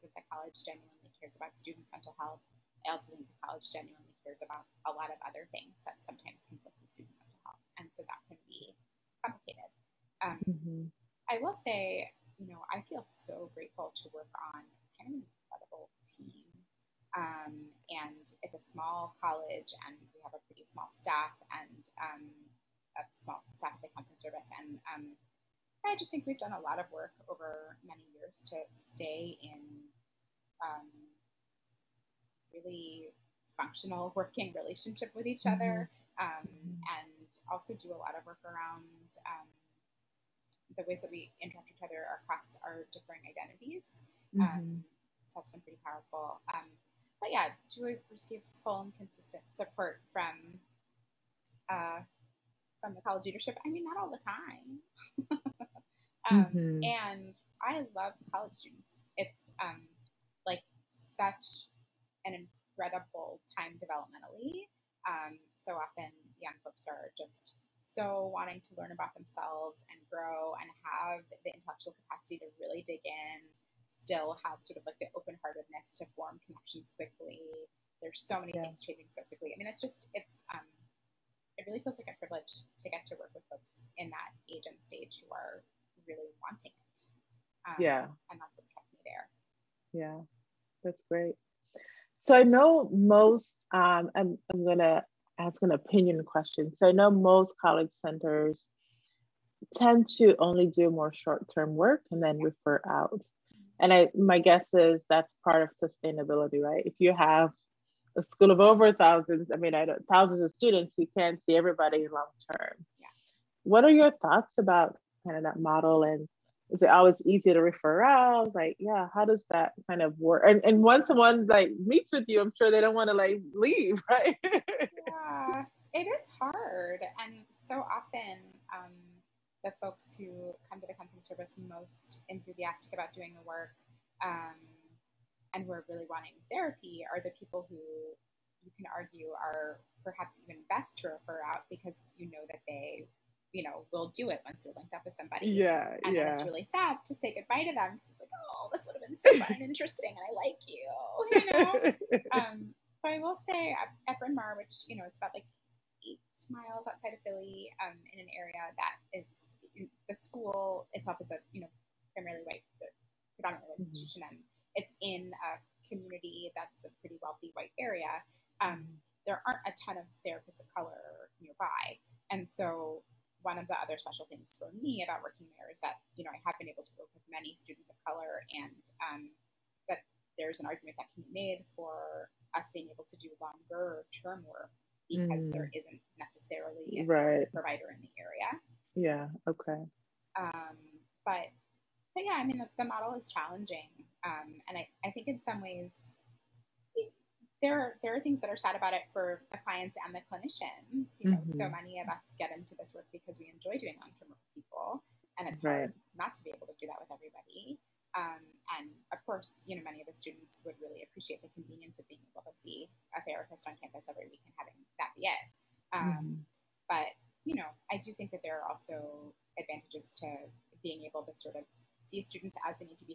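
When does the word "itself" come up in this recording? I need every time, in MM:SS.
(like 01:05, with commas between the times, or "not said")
02:40.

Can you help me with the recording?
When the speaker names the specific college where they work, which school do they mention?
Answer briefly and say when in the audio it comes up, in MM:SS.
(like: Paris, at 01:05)
Bryn Mawr, at 02:34.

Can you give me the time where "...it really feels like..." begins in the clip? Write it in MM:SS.
01:21.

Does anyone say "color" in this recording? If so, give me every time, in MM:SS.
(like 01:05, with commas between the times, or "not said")
02:50, 02:58.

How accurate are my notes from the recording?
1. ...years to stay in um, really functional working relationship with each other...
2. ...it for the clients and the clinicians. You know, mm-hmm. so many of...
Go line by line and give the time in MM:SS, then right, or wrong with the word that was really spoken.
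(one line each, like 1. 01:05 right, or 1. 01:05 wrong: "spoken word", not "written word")
1. 00:28 right
2. 03:18 right.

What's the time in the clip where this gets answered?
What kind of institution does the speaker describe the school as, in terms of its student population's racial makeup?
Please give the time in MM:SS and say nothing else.
02:43.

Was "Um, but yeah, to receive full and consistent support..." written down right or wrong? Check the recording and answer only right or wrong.
right.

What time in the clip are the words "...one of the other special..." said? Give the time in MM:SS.
02:53.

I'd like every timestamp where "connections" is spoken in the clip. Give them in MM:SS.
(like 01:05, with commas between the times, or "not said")
01:16.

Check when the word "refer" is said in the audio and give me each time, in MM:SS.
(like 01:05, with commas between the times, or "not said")
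01:42, 01:57, 02:21.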